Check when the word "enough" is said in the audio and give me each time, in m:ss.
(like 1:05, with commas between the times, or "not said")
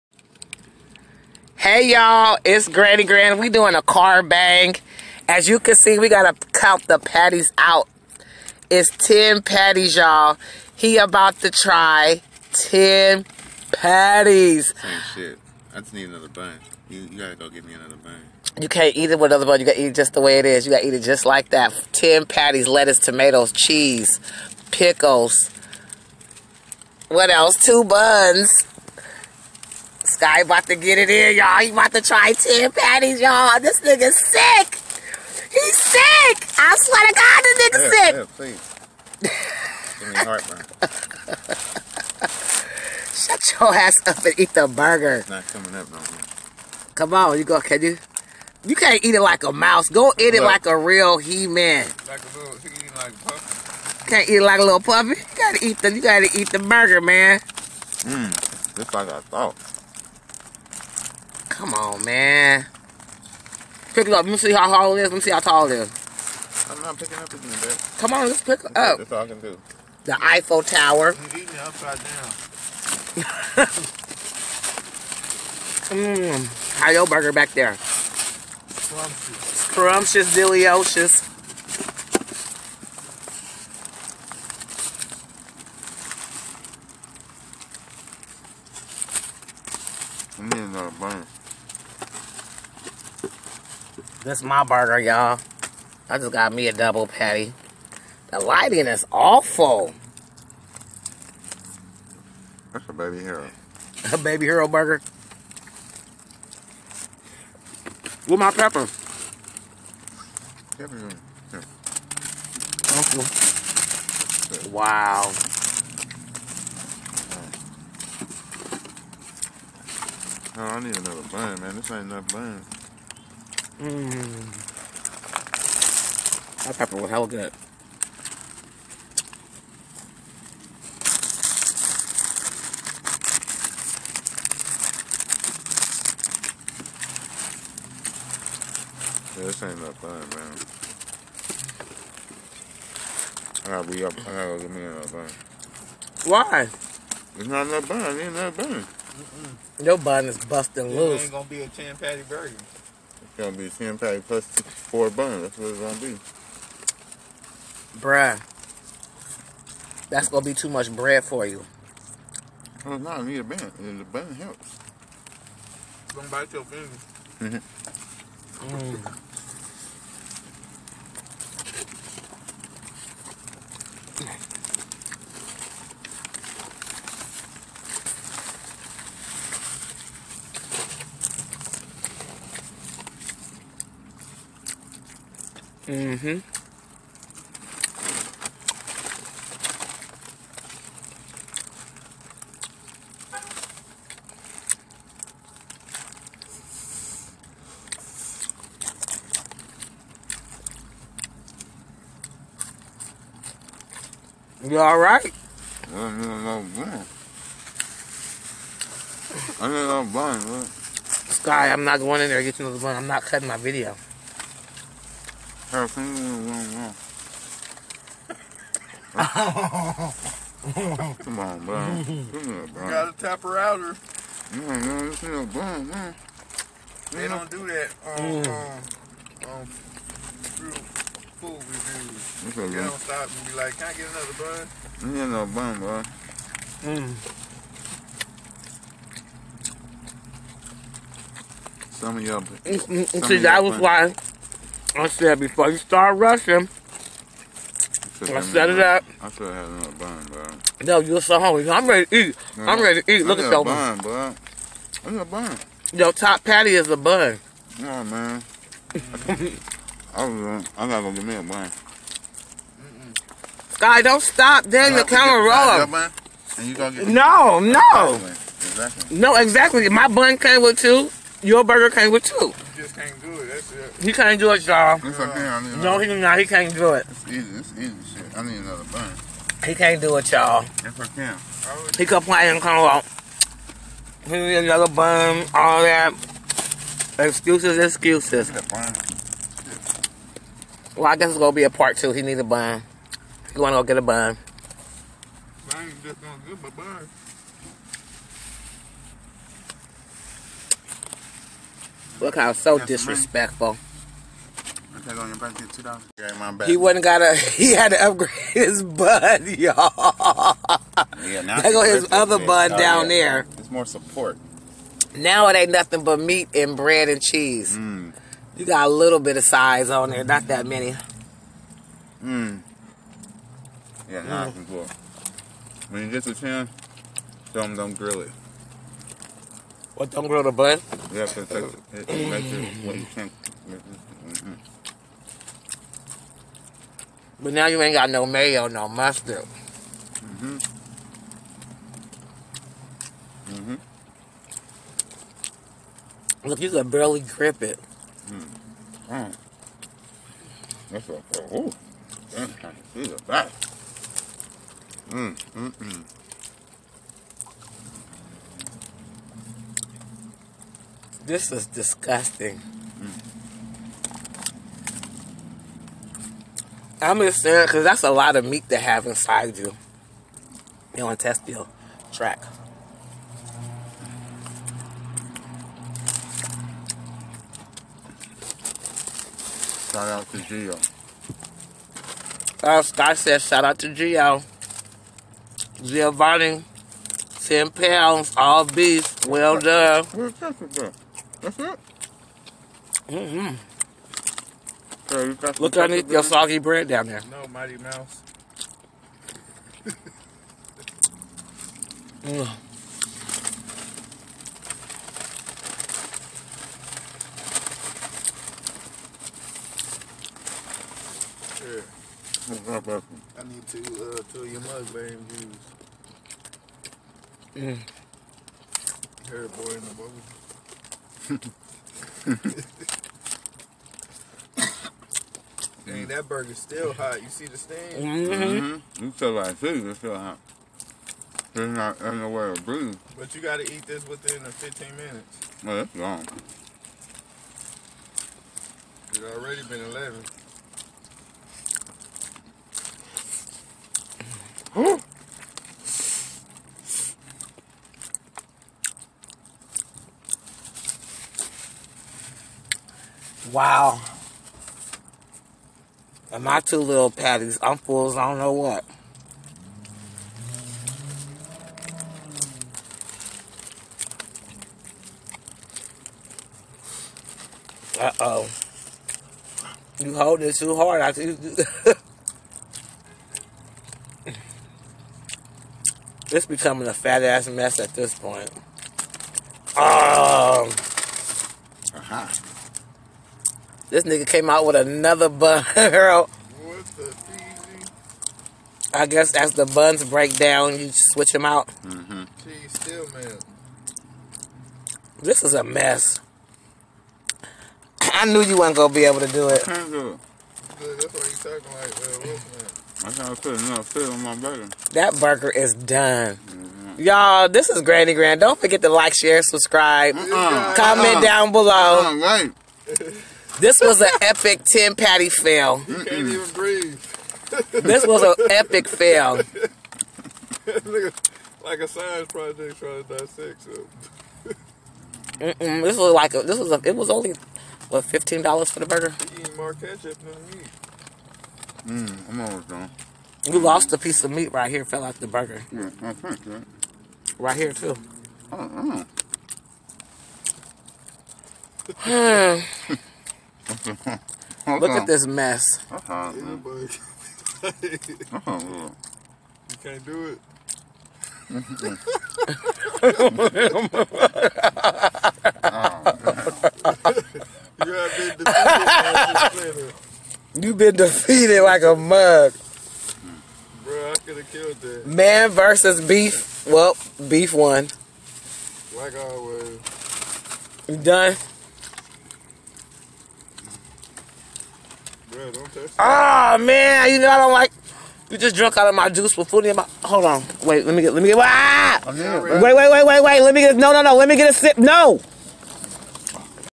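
2:02, 2:27.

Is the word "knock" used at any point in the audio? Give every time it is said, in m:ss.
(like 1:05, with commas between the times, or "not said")
not said.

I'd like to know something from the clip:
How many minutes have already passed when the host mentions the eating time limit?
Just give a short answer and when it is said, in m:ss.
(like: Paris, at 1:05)
11, at 7:19.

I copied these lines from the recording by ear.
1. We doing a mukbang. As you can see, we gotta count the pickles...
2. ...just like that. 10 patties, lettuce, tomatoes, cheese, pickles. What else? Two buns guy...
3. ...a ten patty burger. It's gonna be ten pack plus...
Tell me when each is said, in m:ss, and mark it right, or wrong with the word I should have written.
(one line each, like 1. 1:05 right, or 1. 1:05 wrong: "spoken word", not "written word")
1. 0:03 wrong: "patties", not "pickles"
2. 0:21 right
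3. 2:31 right.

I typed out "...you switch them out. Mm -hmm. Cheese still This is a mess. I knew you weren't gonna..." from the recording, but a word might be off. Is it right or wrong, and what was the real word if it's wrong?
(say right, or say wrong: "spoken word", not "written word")
right.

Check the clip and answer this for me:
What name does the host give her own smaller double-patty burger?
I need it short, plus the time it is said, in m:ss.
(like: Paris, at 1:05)
baby hero burger, at 1:44.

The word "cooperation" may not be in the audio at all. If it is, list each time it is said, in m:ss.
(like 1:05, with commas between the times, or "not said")
not said.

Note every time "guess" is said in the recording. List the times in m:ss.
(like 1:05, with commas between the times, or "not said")
4:51, 8:09.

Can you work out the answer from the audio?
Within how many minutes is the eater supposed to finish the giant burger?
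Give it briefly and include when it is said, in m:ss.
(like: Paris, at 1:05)
15, at 7:14.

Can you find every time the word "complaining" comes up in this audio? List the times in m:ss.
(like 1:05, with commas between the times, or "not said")
4:42.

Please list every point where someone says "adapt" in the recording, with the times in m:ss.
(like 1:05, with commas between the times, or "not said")
not said.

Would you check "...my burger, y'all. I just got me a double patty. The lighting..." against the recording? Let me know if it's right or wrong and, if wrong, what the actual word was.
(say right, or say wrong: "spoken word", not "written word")
right.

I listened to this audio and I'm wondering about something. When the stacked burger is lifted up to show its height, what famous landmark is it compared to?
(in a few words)
The Eiffel Tower.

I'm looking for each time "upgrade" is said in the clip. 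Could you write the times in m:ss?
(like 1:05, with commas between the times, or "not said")
5:08.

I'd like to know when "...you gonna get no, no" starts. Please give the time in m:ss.
4:26.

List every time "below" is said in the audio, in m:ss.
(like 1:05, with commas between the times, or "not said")
8:31.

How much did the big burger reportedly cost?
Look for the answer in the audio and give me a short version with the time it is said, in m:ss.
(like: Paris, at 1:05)
$15, at 8:48.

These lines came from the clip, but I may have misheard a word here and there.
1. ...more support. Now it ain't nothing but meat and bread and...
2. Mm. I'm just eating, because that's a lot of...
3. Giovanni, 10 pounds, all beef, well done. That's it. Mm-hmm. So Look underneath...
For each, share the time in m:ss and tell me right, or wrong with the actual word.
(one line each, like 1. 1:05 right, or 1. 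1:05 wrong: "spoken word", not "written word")
1. 5:13 right
2. 6:02 wrong: "saying", not "eating"
3. 6:25 right.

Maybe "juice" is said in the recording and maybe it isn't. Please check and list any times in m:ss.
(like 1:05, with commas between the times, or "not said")
6:55, 9:39.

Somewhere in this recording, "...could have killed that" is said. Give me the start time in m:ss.
9:24.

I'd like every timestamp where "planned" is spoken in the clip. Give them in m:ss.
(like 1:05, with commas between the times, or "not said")
not said.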